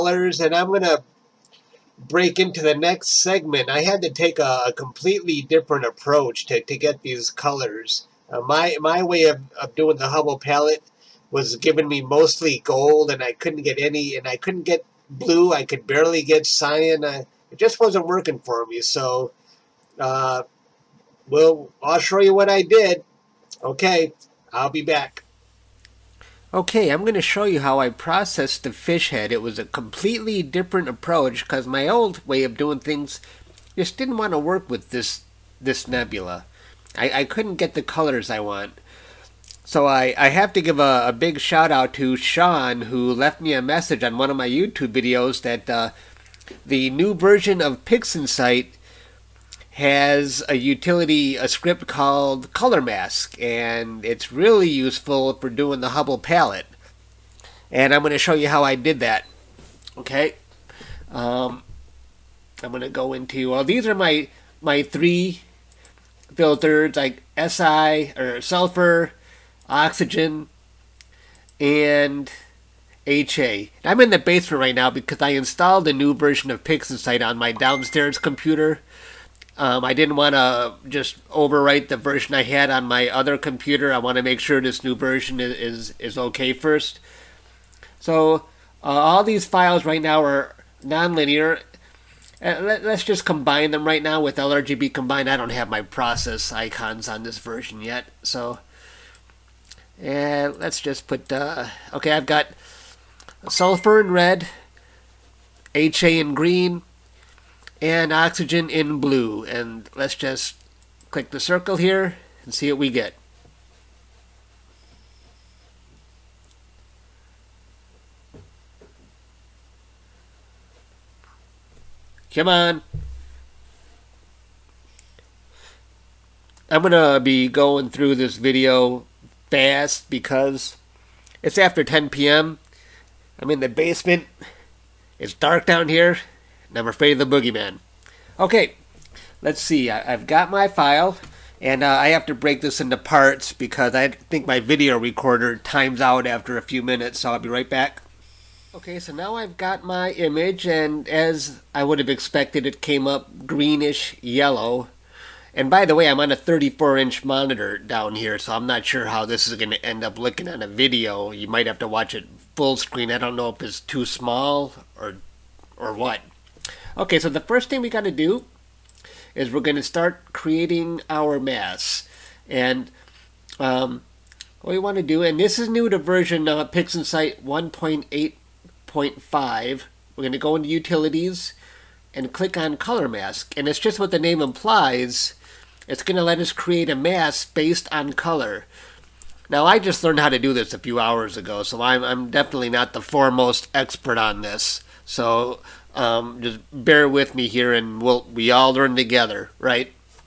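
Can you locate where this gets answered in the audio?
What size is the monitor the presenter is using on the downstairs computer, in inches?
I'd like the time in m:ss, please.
2:36.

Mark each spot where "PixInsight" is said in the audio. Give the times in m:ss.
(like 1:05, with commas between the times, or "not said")
0:47, 1:16, 2:56.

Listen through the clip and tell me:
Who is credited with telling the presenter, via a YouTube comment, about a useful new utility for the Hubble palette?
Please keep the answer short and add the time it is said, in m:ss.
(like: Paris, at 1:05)
Sean, at 0:42.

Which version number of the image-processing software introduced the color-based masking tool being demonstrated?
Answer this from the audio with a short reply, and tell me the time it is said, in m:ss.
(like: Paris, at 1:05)
1.8.5, at 2:56.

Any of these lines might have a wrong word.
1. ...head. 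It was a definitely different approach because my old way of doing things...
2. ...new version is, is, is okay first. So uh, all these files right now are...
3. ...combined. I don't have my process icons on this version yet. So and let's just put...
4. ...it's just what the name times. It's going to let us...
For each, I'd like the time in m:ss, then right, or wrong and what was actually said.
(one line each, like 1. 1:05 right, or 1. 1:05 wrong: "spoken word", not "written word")
1. 0:29 wrong: "completely", not "definitely"
2. 1:24 right
3. 1:34 right
4. 3:03 wrong: "implies", not "times".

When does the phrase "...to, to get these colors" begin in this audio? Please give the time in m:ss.
0:06.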